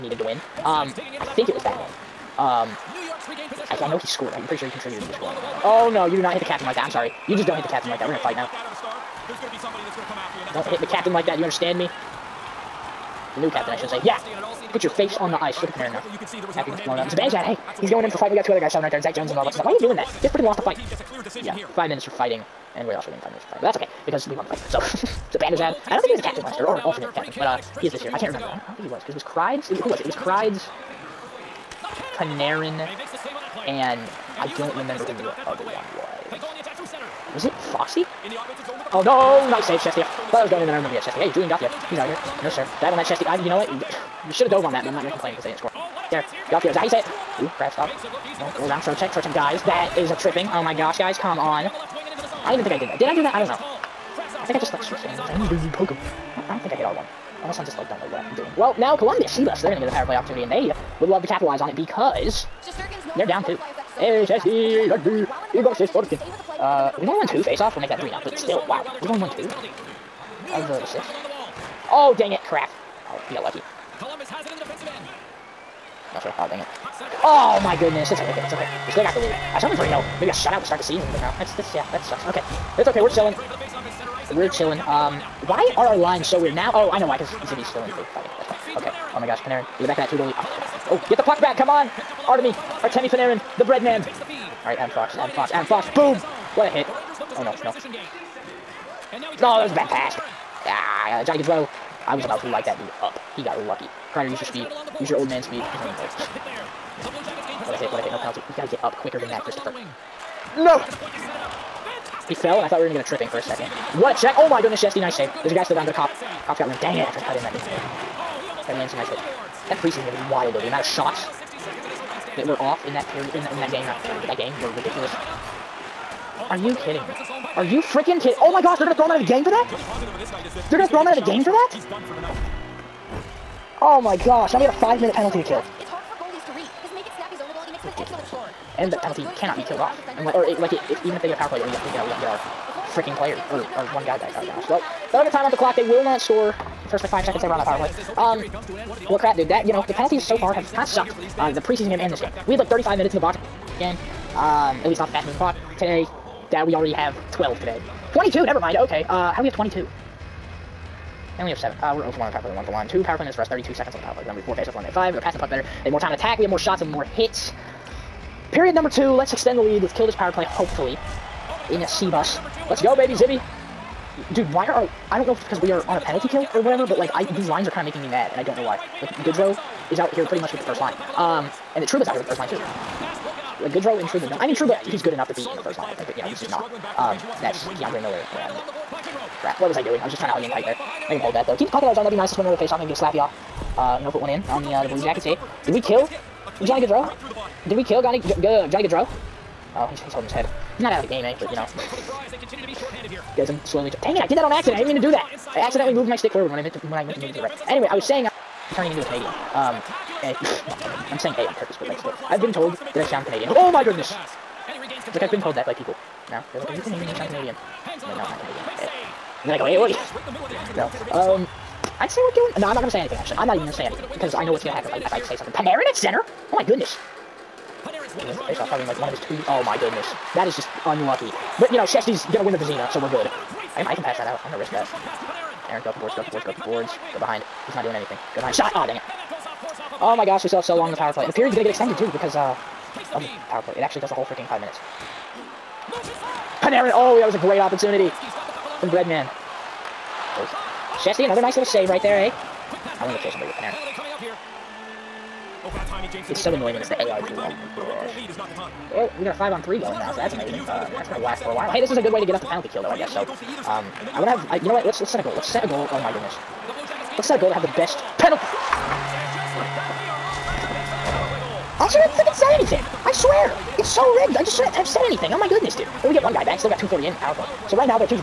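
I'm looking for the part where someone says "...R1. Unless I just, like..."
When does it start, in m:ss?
0:56.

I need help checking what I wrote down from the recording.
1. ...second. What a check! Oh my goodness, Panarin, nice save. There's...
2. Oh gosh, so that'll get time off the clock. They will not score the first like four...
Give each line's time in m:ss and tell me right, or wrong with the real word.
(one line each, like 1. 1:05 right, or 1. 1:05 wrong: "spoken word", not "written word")
1. 1:53 wrong: "Chesty", not "Panarin"
2. 2:24 wrong: "five", not "four".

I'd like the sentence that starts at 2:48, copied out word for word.
Period number two, let's extend the lead, let's kill this power play, hopefully.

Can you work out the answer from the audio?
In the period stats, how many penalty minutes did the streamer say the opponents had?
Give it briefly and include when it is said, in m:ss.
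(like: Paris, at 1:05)
7, at 2:41.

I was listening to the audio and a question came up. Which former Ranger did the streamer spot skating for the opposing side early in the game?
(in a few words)
Julien Gauthier.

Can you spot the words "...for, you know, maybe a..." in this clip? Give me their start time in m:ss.
1:19.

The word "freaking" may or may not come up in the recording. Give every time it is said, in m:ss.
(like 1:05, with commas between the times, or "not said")
0:20, 2:07, 2:22, 4:04, 4:32.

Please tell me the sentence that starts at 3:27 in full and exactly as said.
Anyway, I was saying I'm uh, turning into a Canadian.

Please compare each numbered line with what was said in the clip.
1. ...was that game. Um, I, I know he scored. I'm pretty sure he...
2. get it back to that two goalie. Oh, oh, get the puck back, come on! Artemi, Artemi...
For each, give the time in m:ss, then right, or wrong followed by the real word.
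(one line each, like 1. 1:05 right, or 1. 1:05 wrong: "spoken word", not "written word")
1. 0:01 right
2. 1:29 right.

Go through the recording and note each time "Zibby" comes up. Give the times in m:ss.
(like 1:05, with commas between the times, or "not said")
1:27, 2:53.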